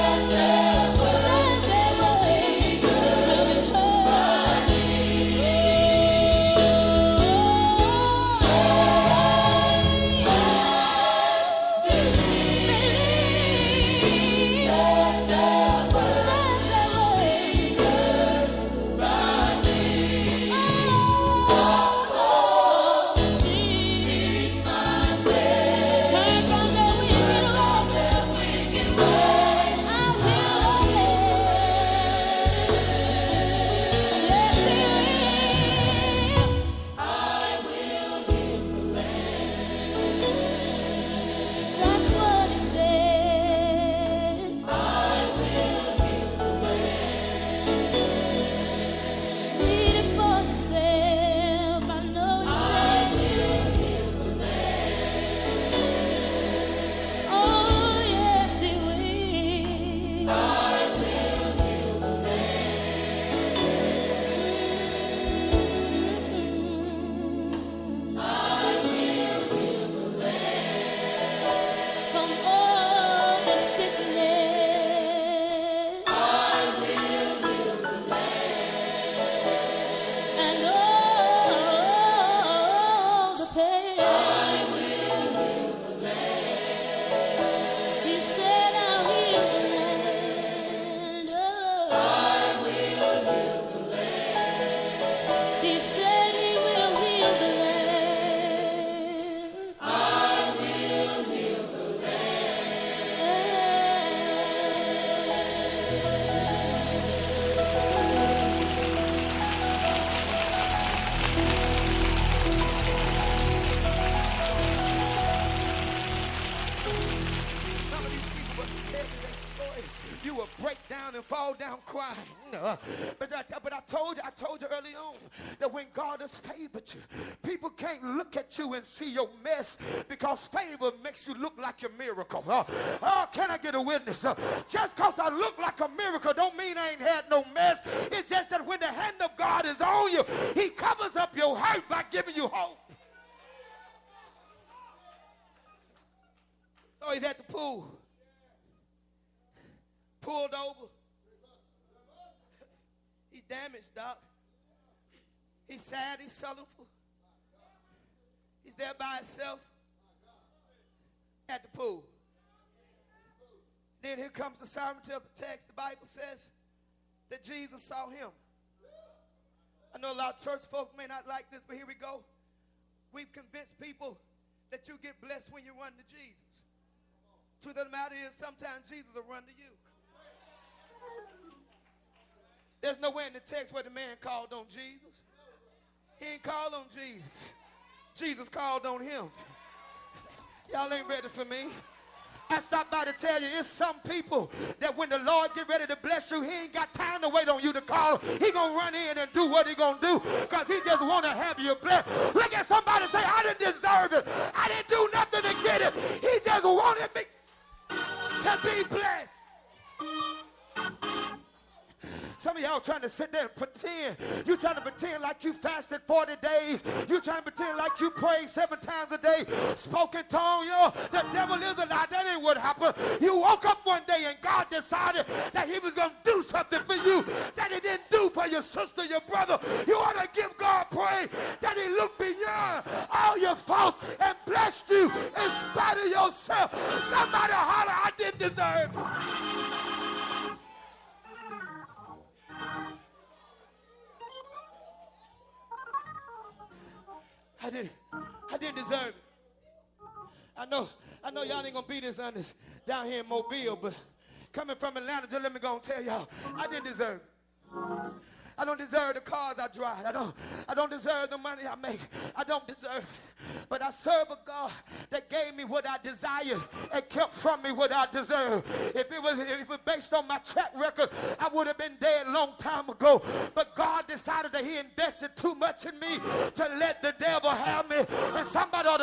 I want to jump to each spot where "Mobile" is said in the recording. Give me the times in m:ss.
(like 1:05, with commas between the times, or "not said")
4:13.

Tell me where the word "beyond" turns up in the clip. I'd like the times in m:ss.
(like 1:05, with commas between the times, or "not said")
3:52.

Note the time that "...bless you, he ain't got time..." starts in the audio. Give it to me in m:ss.
3:16.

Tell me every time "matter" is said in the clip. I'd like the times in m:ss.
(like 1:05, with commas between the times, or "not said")
2:57.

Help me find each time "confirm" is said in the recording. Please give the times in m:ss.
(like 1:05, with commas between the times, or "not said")
not said.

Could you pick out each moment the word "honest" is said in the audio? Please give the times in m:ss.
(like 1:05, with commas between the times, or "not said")
4:12.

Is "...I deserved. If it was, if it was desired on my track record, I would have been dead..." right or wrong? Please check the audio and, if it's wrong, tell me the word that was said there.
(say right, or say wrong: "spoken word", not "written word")
wrong: "based", not "desired".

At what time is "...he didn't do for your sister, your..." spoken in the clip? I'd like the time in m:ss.
3:47.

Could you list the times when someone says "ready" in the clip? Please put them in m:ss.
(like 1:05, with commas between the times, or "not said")
3:11, 3:15.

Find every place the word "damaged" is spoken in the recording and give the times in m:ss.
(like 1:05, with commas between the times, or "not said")
2:33.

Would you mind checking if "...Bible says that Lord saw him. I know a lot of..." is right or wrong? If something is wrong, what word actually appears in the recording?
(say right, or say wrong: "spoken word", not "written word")
wrong: "Jesus", not "Lord".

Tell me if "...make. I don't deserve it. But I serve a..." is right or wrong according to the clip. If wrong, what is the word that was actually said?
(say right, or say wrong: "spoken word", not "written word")
right.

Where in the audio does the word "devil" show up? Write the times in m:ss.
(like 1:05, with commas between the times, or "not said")
3:41, 4:37.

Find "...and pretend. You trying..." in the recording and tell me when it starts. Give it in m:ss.
3:33.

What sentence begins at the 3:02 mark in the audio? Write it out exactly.
There's nowhere in the text where the man called on Jesus.